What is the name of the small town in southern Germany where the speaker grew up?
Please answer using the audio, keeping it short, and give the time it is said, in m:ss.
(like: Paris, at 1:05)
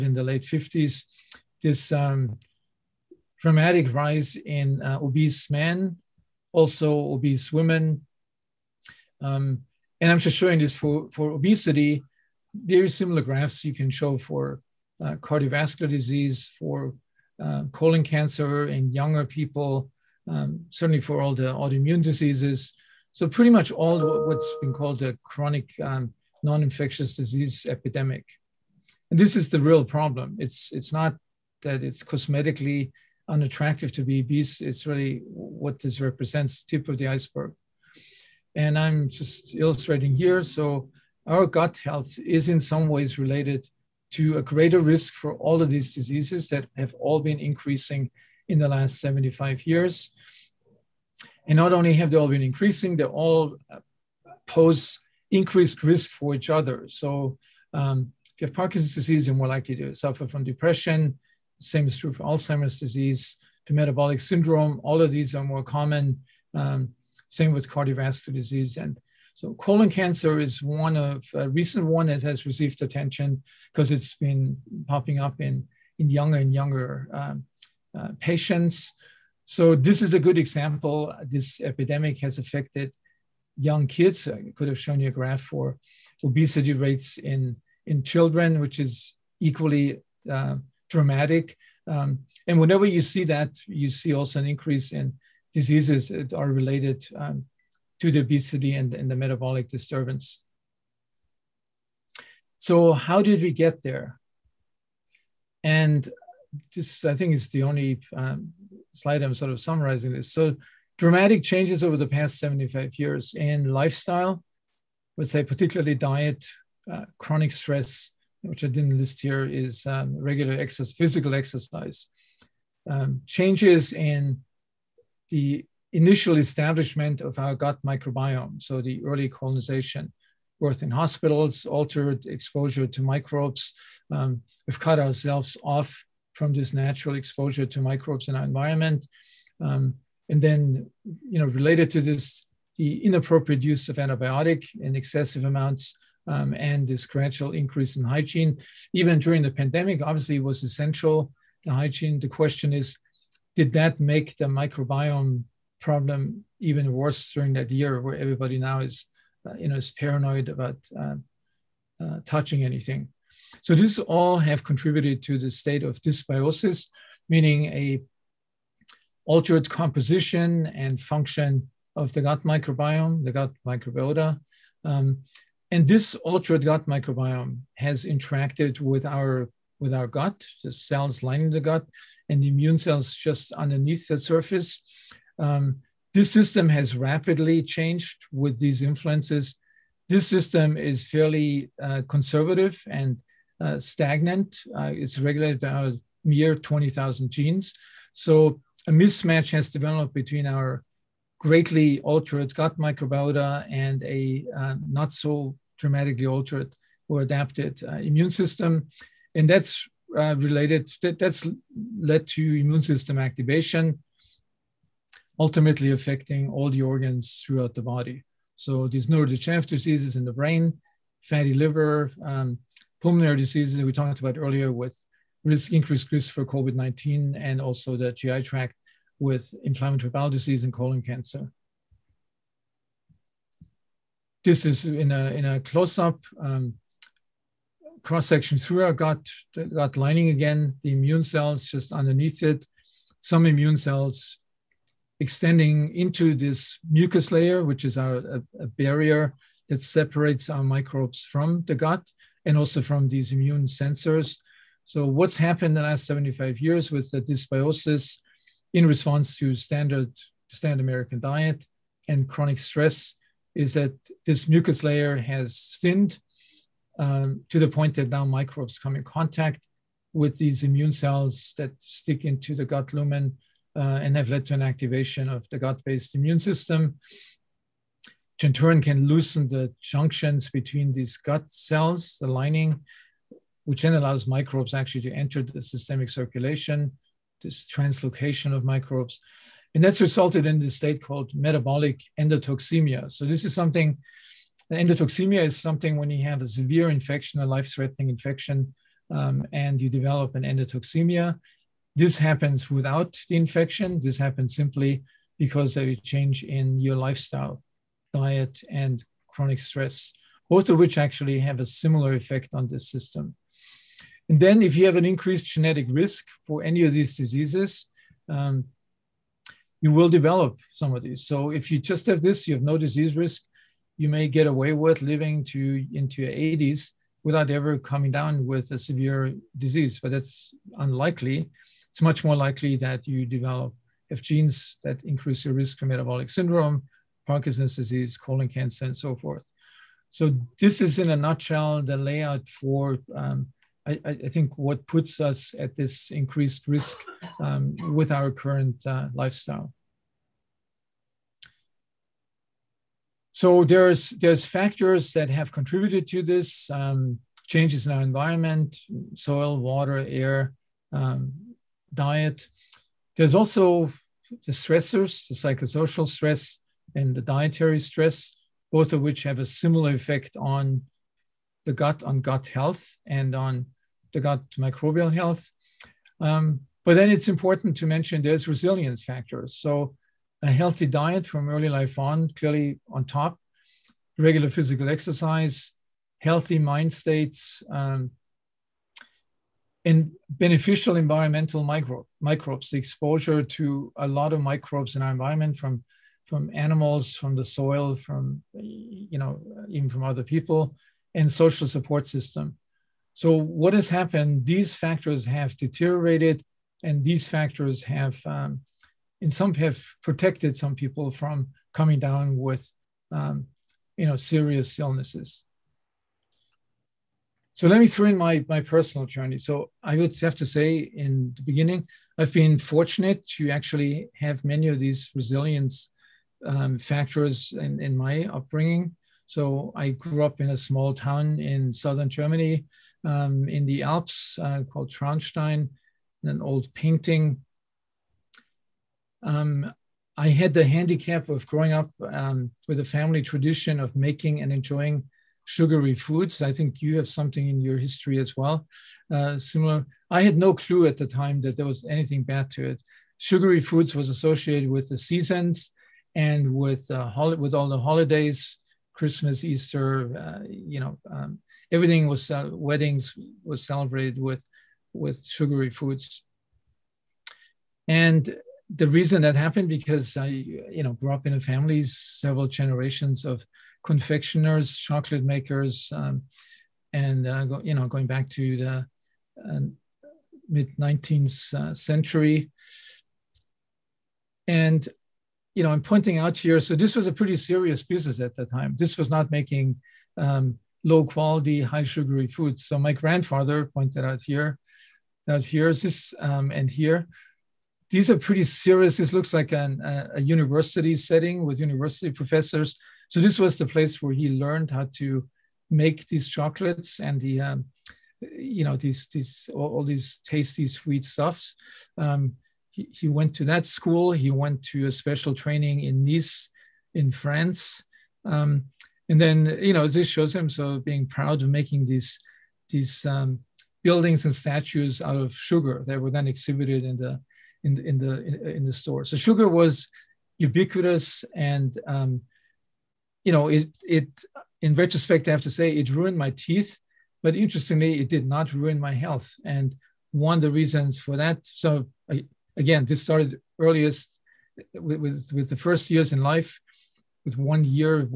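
Traunstein, at 7:14.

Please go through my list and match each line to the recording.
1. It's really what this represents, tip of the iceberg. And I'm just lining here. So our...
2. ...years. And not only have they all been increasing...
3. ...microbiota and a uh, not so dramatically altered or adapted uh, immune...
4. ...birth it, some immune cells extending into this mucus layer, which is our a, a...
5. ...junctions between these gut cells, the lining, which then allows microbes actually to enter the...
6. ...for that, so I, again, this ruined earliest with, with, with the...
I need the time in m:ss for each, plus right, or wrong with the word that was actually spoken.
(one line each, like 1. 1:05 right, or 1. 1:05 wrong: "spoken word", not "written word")
1. 0:34 wrong: "illustrating", not "lining"
2. 0:49 right
3. 3:22 right
4. 4:01 wrong: "underneath", not "birth"
5. 4:39 right
6. 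9:00 wrong: "started", not "ruined".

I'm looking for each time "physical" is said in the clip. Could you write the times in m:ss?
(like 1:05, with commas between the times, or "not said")
2:00, 6:24.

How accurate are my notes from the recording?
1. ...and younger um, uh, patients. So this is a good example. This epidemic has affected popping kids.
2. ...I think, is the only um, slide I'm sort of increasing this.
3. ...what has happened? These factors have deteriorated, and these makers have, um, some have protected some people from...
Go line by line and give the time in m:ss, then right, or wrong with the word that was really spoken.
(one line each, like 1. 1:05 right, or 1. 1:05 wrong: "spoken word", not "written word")
1. 1:16 wrong: "young", not "popping"
2. 1:47 wrong: "summarizing", not "increasing"
3. 6:43 wrong: "factors", not "makers".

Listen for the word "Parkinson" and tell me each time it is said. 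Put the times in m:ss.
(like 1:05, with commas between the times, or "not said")
0:58, 5:37.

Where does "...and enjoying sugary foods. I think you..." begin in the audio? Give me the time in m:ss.
7:24.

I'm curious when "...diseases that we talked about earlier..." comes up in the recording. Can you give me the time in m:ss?
3:43.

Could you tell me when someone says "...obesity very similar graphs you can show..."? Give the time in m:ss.
0:11.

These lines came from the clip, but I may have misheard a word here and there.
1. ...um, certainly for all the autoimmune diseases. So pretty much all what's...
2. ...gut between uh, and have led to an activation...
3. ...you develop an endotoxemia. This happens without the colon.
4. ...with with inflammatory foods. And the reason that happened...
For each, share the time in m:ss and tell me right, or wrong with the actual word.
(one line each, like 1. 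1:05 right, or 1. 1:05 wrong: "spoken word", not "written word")
1. 0:20 right
2. 4:32 wrong: "lumen", not "between"
3. 4:59 wrong: "infection", not "colon"
4. 7:44 wrong: "sugary", not "inflammatory".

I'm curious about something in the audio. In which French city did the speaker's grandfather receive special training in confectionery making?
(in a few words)
Nice.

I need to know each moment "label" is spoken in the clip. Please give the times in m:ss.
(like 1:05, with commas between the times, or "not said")
not said.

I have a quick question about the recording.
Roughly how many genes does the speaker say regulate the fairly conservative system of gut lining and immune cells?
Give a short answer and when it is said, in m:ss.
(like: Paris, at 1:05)
20,000, at 3:16.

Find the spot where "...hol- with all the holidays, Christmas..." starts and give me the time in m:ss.
7:37.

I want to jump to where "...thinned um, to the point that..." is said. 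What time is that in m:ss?
4:25.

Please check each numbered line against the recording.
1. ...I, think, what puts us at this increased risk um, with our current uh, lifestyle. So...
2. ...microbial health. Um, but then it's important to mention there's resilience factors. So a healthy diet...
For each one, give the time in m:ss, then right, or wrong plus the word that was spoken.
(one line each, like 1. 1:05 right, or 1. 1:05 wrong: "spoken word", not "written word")
1. 5:44 right
2. 6:14 right.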